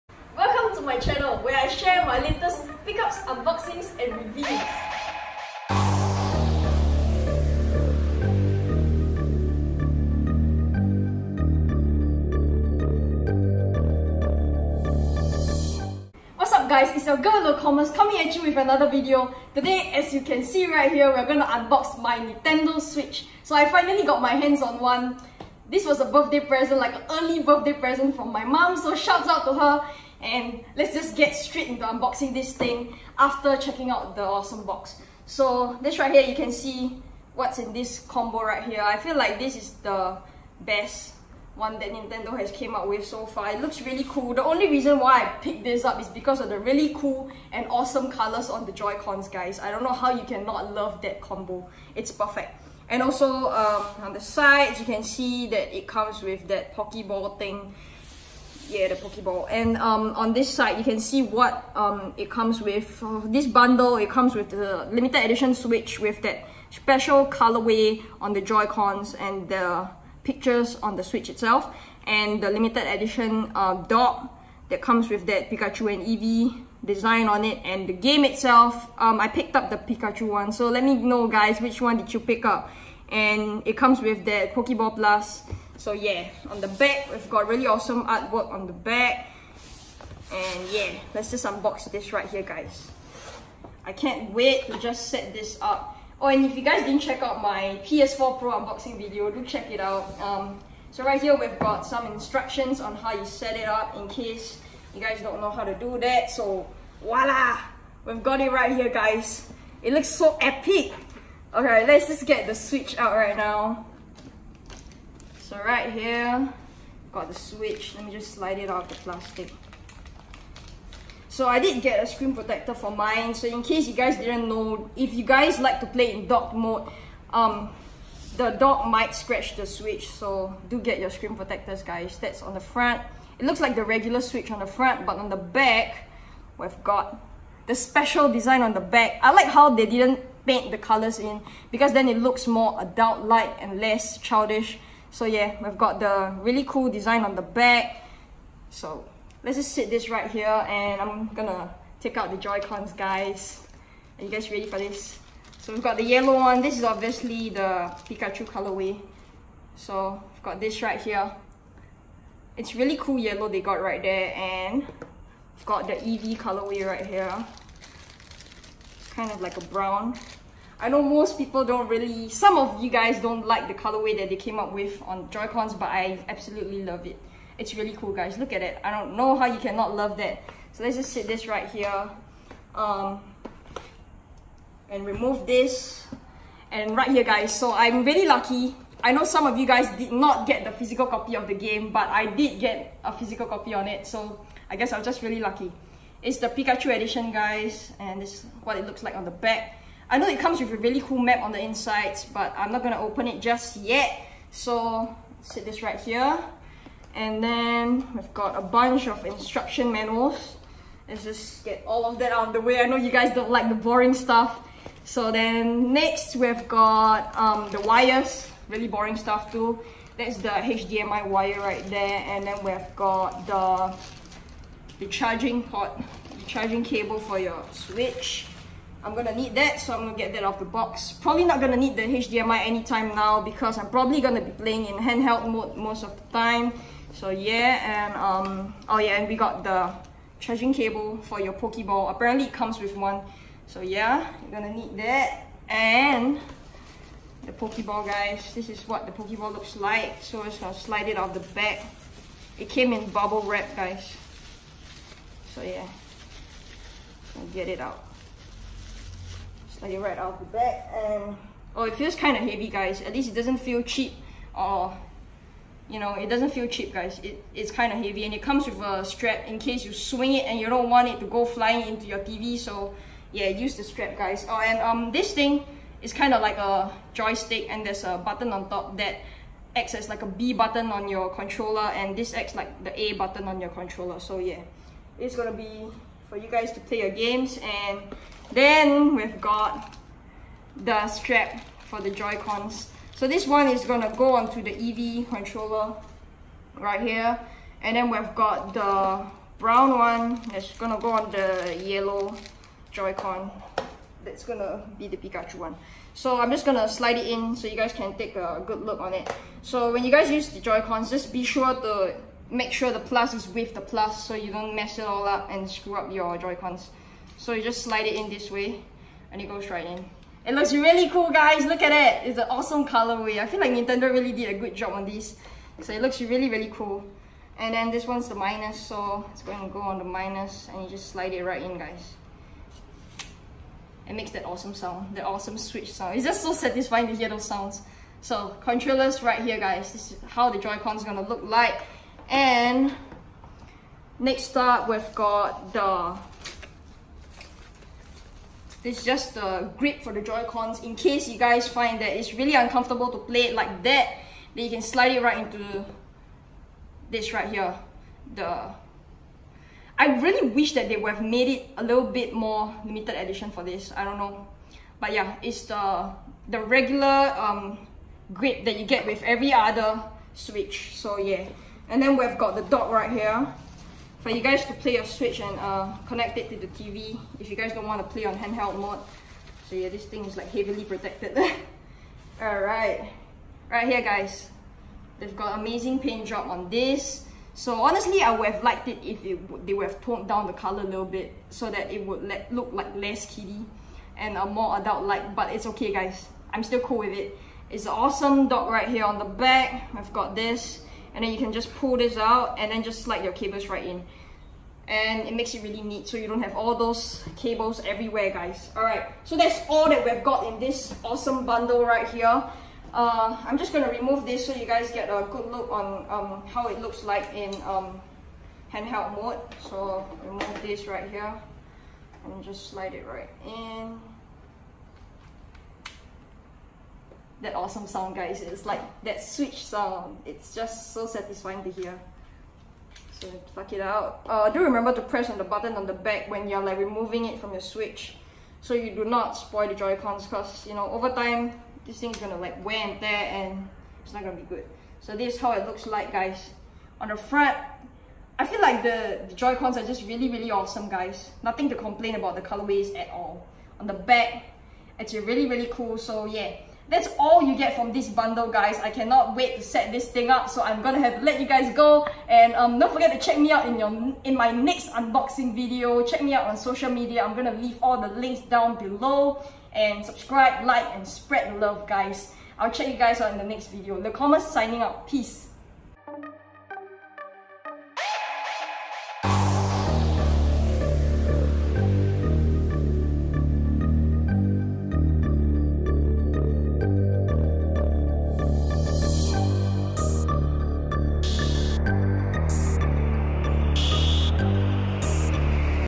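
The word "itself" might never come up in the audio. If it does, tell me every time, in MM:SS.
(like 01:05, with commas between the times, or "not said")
01:11, 01:18.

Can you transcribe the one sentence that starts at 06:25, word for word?
They've got amazing paint job on this.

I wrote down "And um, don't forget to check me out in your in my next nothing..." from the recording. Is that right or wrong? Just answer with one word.
wrong.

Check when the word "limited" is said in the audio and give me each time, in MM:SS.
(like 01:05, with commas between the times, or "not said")
01:04, 01:12, 06:02.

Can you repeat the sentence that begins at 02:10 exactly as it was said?
So do get your screen protectors, guys.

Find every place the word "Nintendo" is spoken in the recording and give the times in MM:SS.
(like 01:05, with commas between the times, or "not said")
00:22, 00:41, 05:23.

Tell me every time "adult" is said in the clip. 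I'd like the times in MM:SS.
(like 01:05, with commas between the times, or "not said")
02:22, 06:34.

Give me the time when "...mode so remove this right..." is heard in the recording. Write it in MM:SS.
06:59.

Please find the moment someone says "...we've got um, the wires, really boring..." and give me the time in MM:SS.
03:36.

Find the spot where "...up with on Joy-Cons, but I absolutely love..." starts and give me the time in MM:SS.
02:54.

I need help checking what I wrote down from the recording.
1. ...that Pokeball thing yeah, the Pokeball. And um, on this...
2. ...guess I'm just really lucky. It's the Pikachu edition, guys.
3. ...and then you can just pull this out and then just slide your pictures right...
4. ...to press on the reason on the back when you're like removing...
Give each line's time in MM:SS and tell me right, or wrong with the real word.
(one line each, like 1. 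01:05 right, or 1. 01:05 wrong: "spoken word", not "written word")
1. 00:56 right
2. 03:14 right
3. 06:41 wrong: "cables", not "pictures"
4. 07:14 wrong: "button", not "reason".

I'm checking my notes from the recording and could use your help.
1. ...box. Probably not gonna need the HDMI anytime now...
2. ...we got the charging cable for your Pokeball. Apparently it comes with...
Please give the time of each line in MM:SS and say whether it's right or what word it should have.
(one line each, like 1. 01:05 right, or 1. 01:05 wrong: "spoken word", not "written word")
1. 03:50 right
2. 03:59 right.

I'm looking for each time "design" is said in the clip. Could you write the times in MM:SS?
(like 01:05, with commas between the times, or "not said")
01:16, 02:18, 02:26.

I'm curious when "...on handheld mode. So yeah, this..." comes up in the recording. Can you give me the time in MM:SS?
06:18.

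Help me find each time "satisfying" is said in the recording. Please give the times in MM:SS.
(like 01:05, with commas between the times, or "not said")
05:36, 07:11.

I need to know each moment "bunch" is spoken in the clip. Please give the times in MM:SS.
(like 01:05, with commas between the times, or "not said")
03:28.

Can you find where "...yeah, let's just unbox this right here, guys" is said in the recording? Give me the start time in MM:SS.
01:30.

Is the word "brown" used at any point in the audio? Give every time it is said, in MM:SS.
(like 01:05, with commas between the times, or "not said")
02:49, 04:59.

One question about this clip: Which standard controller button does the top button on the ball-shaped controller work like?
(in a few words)
B button.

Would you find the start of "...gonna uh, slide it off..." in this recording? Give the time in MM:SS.
04:10.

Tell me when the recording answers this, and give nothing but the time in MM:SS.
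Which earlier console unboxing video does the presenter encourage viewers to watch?
01:37.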